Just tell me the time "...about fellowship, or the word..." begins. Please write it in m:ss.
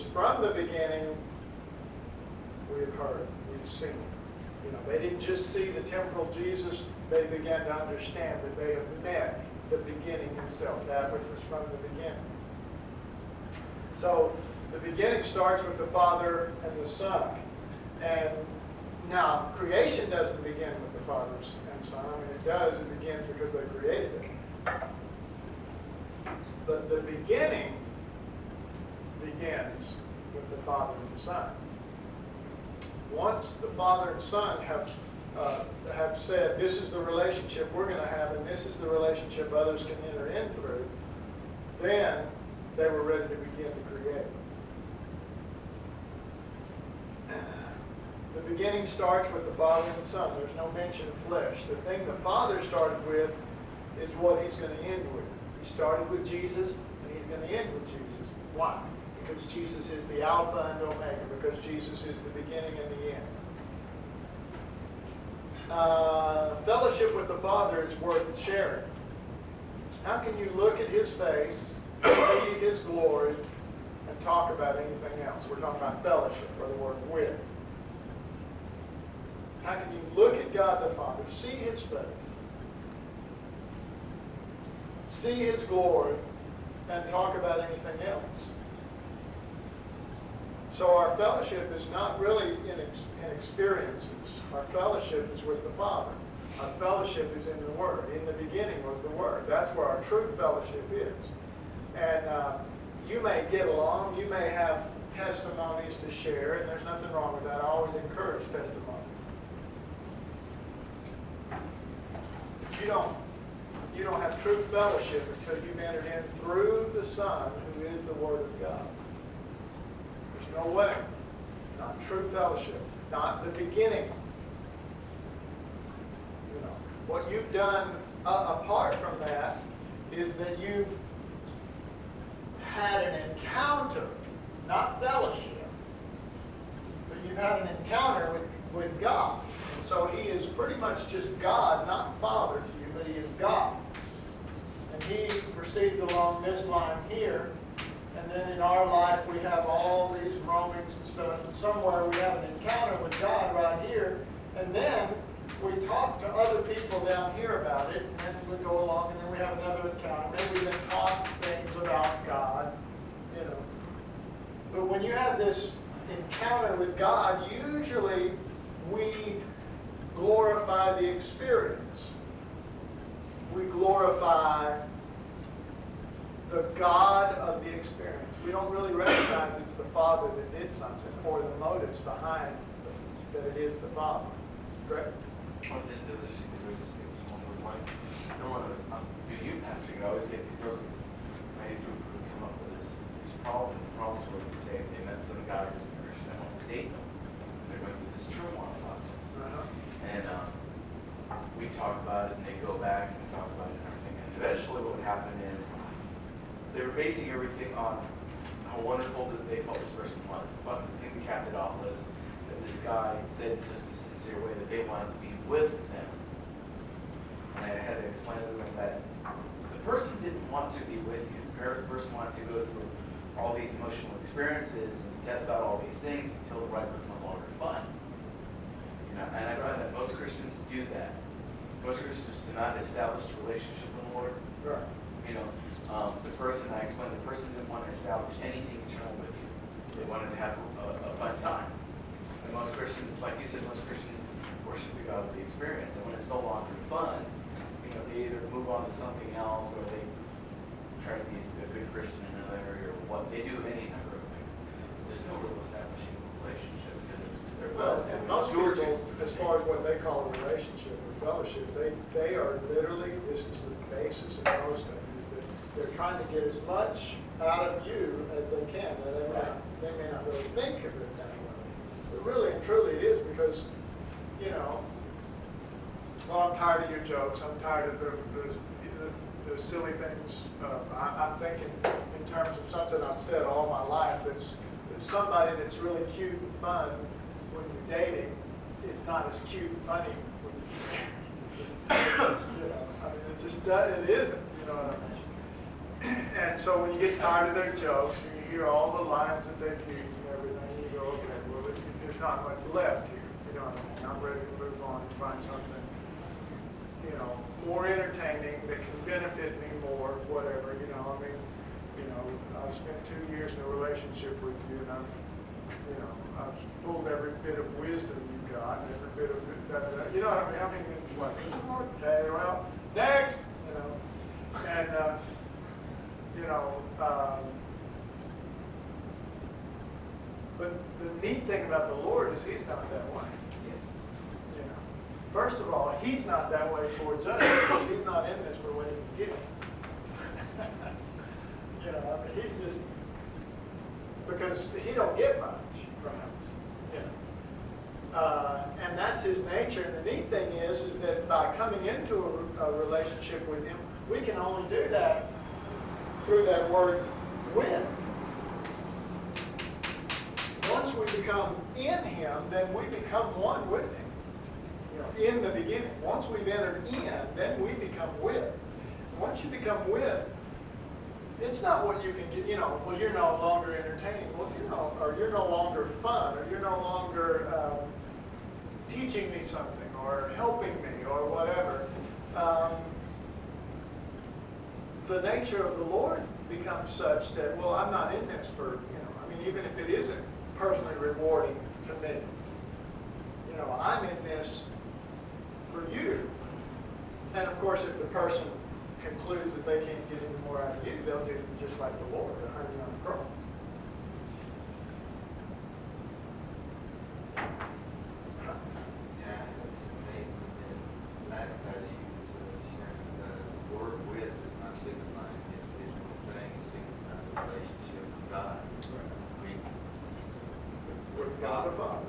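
1:15.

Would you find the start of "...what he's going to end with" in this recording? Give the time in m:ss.
0:54.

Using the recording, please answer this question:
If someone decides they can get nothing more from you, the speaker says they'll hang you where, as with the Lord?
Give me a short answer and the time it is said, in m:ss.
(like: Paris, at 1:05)
On the cross, at 6:42.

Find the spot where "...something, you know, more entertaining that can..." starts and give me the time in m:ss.
5:05.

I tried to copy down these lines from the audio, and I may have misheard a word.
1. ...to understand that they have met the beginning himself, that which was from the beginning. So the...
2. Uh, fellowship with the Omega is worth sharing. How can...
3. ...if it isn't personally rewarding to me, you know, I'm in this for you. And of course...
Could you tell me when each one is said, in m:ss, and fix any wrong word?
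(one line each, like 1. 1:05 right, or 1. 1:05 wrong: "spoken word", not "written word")
1. 0:07 right
2. 1:05 wrong: "Father", not "Omega"
3. 6:29 right.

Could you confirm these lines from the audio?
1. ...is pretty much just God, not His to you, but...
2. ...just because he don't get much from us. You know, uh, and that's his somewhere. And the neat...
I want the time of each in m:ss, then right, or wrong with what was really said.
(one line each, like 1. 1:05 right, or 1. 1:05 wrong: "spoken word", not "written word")
1. 2:20 wrong: "Father", not "His"
2. 5:42 wrong: "nature", not "somewhere".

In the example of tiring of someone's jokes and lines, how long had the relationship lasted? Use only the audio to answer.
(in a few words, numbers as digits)
2 years.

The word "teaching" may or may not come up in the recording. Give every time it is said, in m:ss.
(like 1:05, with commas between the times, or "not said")
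6:18.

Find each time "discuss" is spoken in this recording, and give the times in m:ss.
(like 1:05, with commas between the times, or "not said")
not said.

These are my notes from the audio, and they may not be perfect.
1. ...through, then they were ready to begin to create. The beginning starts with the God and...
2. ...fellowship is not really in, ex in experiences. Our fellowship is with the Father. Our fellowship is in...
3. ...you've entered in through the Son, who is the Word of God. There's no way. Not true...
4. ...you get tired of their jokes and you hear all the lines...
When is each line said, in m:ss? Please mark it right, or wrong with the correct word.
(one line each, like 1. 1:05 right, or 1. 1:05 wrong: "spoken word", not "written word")
1. 0:40 wrong: "Father", not "God"
2. 1:31 right
3. 1:55 right
4. 4:56 right.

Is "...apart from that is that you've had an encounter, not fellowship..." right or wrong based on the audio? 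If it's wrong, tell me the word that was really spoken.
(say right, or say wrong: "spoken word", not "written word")
right.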